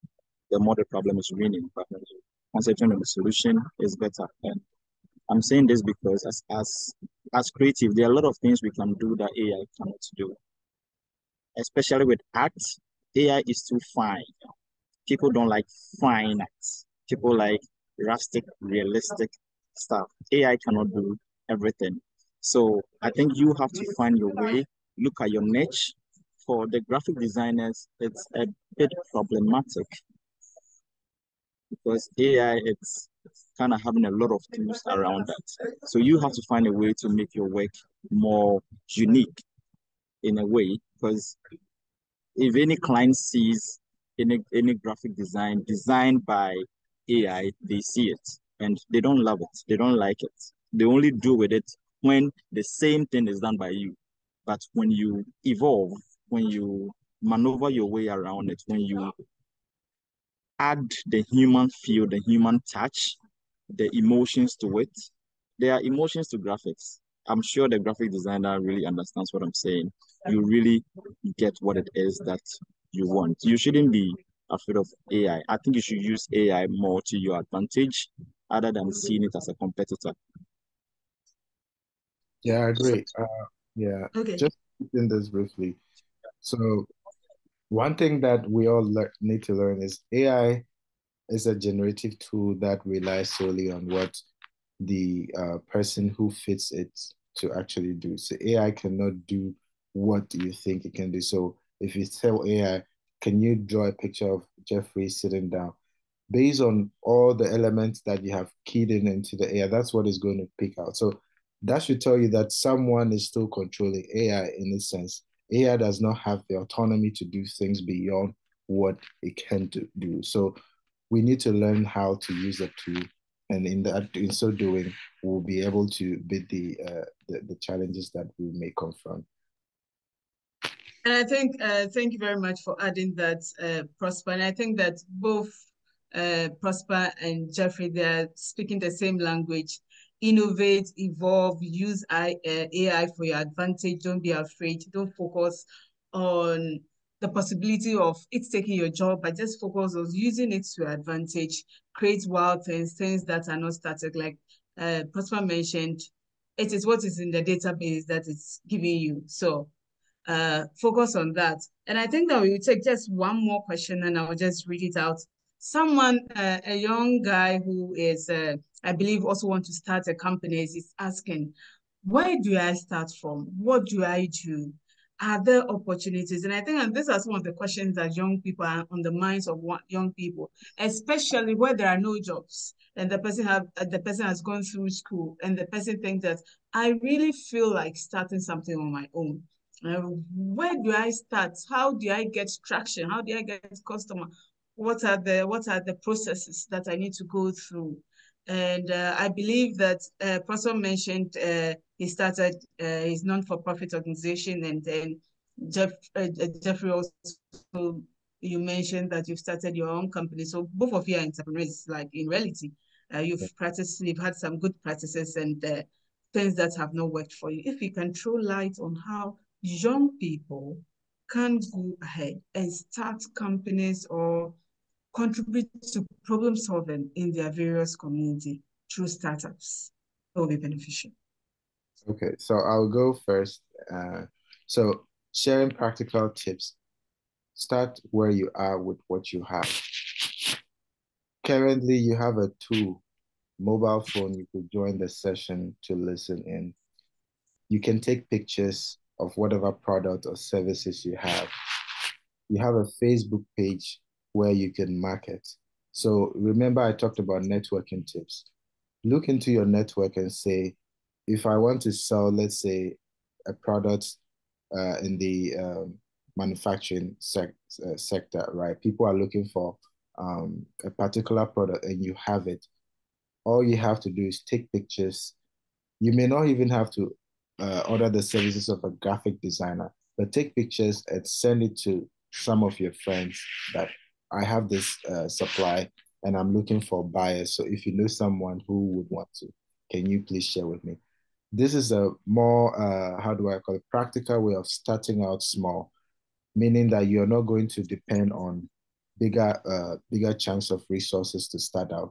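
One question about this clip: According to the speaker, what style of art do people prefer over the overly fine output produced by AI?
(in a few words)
Rustic, realistic.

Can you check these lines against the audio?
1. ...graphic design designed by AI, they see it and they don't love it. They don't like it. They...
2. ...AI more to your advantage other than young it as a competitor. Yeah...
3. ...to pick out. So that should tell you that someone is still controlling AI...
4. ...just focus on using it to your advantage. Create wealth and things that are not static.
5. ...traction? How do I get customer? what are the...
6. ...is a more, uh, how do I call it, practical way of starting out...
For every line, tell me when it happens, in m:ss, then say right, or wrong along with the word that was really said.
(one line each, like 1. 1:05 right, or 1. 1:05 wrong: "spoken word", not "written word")
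1. 0:44 right
2. 1:16 wrong: "seeing", not "young"
3. 1:50 right
4. 2:29 right
5. 3:12 right
6. 4:51 right.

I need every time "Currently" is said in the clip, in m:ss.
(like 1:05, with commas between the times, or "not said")
4:01.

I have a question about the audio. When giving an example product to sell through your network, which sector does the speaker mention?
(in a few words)
Manufacturing.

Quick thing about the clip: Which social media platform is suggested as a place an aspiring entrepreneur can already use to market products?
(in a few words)
Facebook.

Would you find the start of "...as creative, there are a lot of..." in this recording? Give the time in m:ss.
0:07.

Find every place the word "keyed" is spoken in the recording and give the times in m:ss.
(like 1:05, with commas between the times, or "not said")
1:48.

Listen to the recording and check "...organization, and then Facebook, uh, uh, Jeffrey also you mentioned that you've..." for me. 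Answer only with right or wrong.
wrong.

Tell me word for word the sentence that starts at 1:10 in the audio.
You really get what it is that you want.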